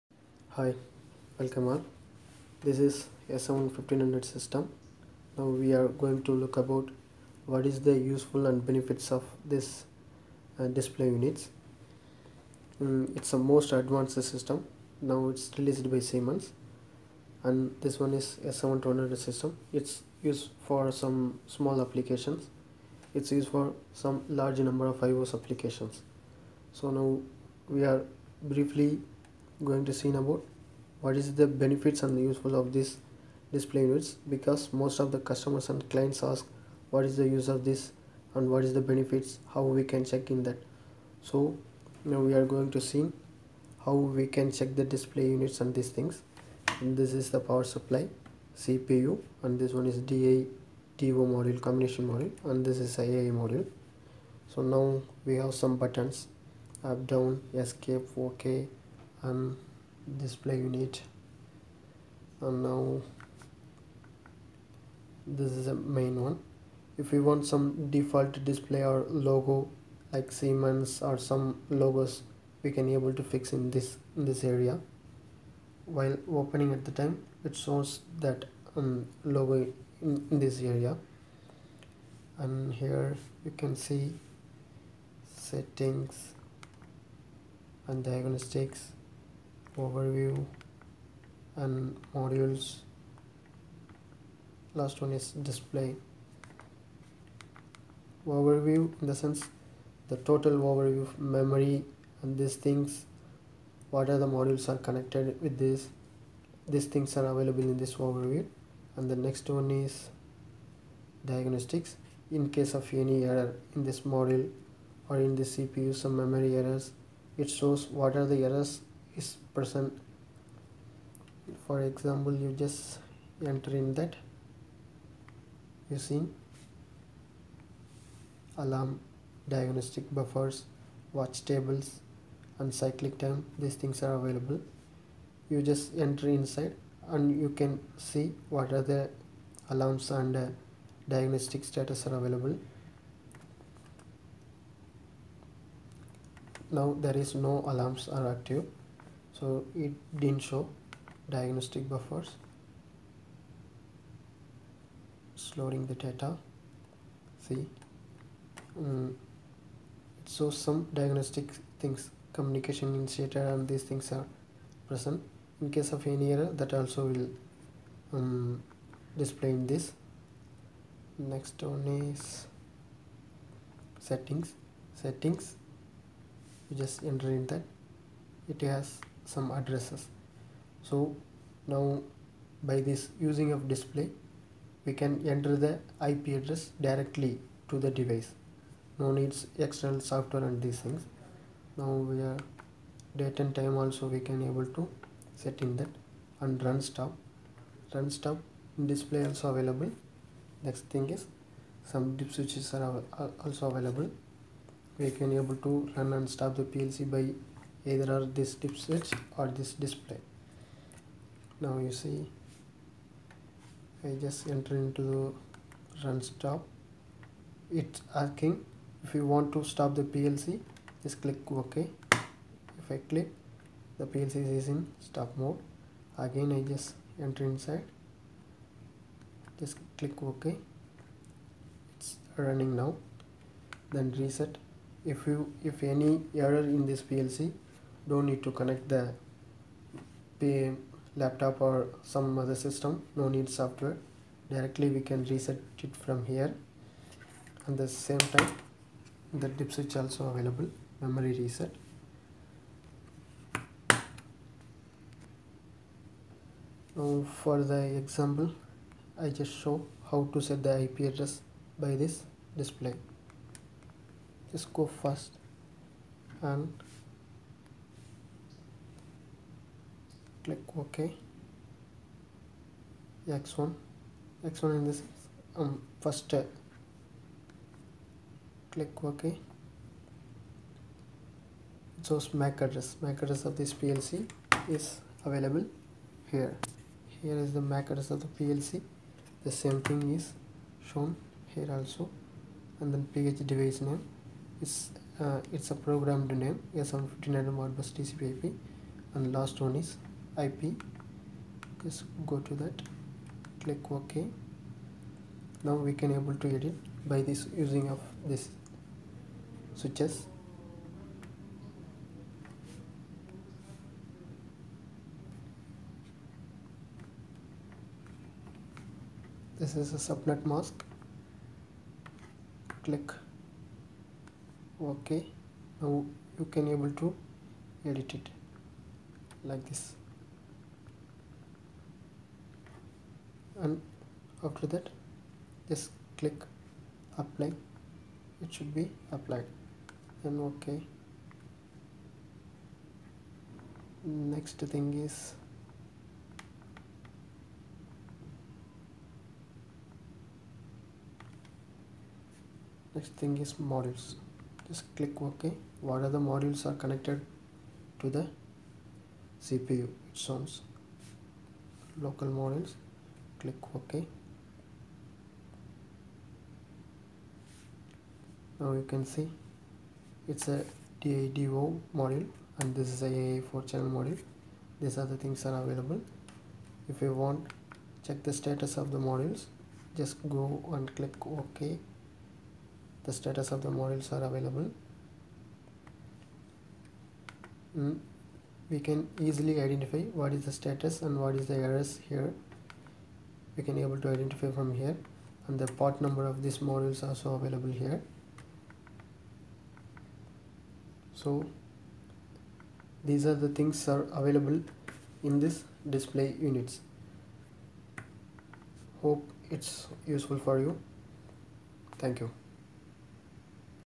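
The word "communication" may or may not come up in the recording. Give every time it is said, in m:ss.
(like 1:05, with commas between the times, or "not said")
2:42.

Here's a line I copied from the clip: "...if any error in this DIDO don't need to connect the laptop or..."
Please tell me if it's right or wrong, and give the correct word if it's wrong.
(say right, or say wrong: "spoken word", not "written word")
wrong: "PLC", not "DIDO".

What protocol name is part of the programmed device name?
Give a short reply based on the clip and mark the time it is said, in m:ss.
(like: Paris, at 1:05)
Modbus TCP IP, at 4:57.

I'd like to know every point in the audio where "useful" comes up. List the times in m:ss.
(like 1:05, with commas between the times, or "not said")
0:07, 0:32, 6:50.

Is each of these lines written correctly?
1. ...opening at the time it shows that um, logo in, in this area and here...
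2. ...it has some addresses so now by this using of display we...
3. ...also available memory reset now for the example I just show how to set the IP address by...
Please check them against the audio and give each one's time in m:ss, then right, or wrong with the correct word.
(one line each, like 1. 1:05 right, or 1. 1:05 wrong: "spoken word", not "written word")
1. 1:16 right
2. 2:58 right
3. 4:10 right.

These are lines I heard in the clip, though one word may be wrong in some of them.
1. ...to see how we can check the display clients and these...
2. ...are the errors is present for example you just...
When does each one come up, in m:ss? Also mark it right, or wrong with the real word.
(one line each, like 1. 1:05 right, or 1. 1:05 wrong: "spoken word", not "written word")
1. 0:42 wrong: "units", not "clients"
2. 1:58 right.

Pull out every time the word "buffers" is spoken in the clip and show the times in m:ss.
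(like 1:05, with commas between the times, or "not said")
2:10, 2:31.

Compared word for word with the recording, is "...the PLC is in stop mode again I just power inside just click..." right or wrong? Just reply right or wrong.
wrong.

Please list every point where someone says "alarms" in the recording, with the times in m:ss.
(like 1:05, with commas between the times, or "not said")
2:08, 2:19, 2:27.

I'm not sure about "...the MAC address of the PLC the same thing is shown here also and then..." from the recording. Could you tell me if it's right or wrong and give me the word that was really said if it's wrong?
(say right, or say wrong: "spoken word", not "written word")
right.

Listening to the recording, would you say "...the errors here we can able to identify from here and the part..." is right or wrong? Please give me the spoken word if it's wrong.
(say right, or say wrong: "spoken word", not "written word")
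right.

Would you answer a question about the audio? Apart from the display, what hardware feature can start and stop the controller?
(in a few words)
dip switches.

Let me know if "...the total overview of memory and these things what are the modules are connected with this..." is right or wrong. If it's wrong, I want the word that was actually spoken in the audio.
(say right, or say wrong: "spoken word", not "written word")
right.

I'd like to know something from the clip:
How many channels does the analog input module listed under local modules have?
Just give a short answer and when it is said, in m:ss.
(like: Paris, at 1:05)
4, at 6:13.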